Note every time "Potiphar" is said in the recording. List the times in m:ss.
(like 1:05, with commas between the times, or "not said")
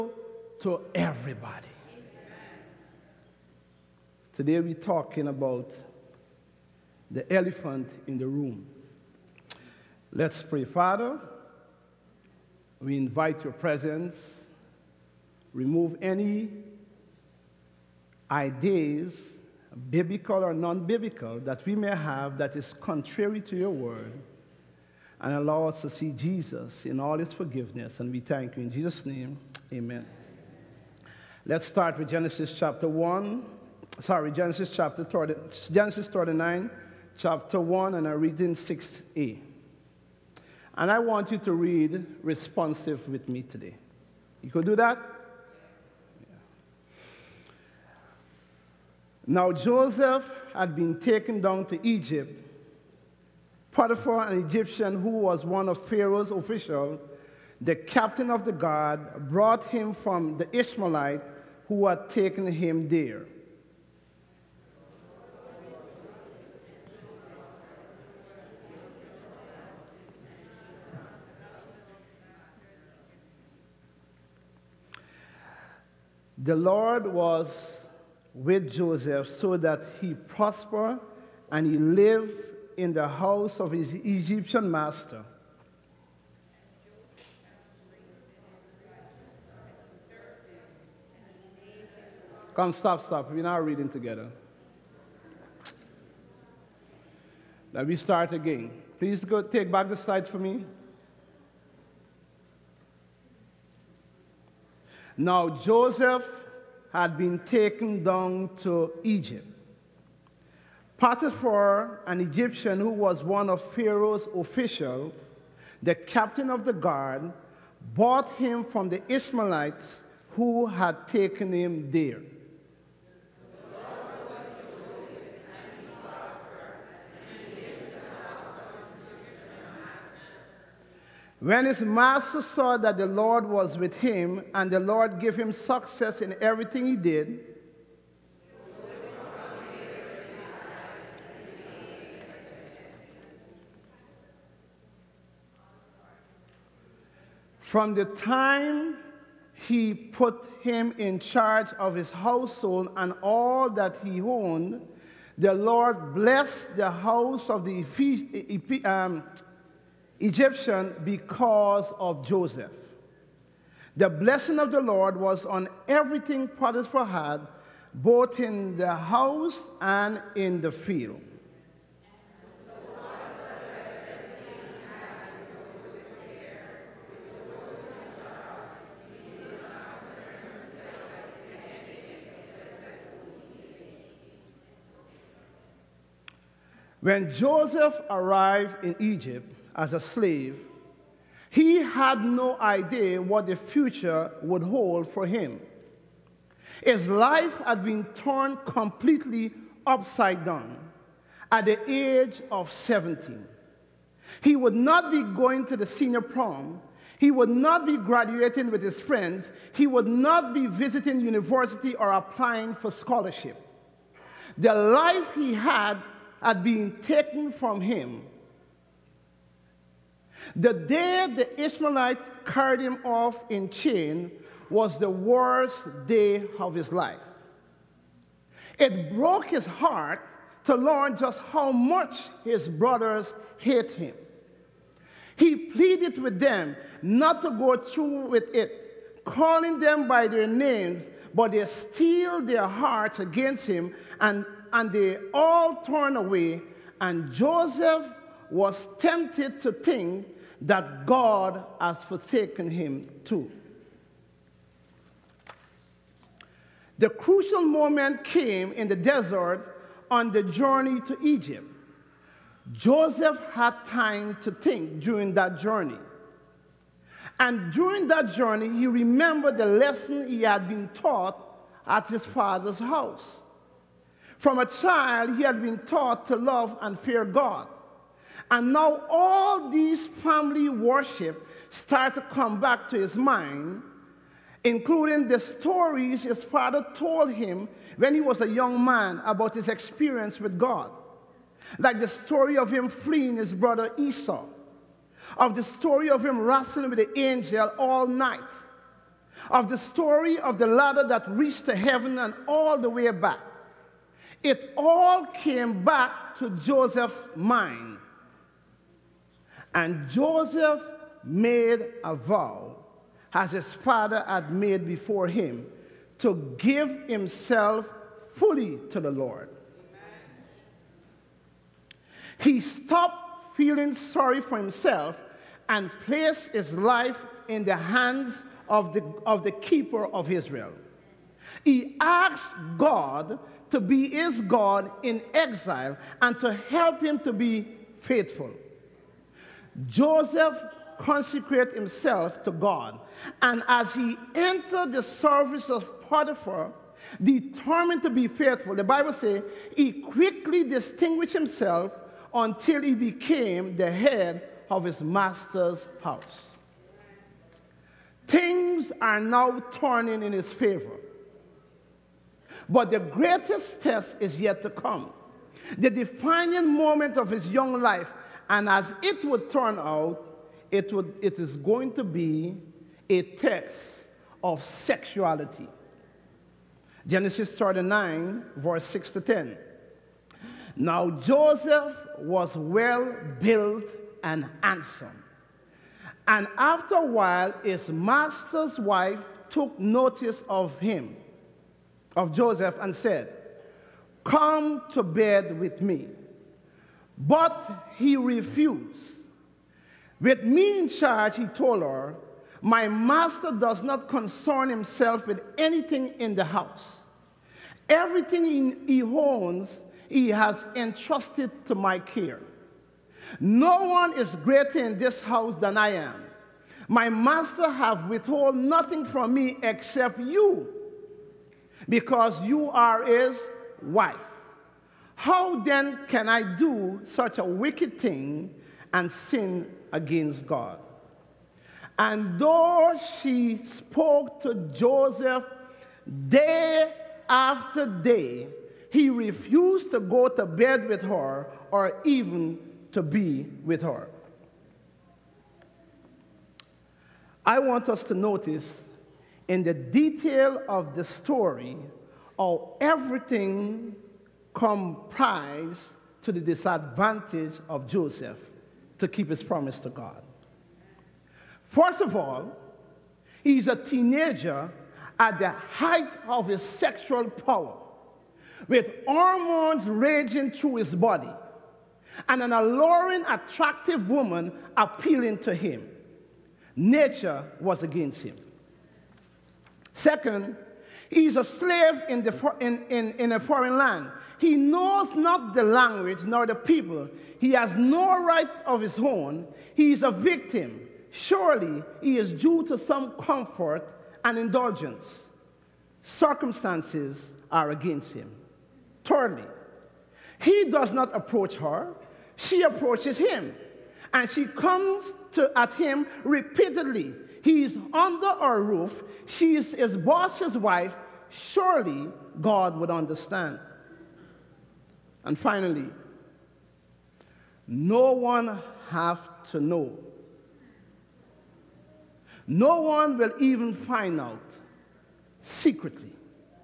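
0:53, 1:50, 2:46, 5:46.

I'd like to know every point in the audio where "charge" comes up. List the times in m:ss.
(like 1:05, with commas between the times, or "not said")
2:31, 6:40.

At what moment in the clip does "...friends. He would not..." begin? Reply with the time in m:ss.
3:28.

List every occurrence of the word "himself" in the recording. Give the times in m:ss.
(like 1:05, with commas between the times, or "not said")
5:17, 5:24, 5:41, 5:51, 6:44.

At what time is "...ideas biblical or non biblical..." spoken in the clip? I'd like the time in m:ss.
0:18.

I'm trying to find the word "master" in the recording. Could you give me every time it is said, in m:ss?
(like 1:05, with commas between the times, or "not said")
1:24, 2:11, 5:55, 6:27, 6:42, 6:57.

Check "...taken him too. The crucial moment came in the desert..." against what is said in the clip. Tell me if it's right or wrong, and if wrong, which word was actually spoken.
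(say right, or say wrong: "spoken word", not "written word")
wrong: "forsaken", not "taken".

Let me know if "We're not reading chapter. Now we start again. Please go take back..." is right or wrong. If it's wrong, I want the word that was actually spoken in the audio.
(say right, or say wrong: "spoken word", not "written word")
wrong: "together", not "chapter".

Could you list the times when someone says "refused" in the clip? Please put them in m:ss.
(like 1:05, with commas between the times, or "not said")
6:38, 7:19.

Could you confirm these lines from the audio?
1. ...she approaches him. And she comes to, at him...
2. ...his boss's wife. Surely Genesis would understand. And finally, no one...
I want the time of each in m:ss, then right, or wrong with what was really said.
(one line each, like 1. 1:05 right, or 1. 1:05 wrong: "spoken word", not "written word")
1. 8:22 right
2. 8:29 wrong: "God", not "Genesis".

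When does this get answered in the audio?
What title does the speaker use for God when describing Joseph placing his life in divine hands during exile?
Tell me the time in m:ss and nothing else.
5:29.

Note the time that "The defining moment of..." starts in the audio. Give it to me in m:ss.
6:05.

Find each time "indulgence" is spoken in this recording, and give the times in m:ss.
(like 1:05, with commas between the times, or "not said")
8:14.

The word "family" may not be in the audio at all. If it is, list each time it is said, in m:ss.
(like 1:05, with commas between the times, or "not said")
4:40.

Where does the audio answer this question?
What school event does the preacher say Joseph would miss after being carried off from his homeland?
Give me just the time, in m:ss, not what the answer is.
3:25.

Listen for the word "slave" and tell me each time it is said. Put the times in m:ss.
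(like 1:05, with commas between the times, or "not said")
3:09, 8:01.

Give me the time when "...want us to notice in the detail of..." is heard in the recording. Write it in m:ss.
7:27.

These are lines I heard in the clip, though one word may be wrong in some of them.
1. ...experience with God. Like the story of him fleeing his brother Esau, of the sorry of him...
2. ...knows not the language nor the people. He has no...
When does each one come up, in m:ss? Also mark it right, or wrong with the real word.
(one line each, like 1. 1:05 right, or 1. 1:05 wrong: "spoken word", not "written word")
1. 4:49 wrong: "story", not "sorry"
2. 8:04 right.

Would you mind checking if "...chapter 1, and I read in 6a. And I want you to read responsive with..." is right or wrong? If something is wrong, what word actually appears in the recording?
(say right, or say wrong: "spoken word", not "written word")
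right.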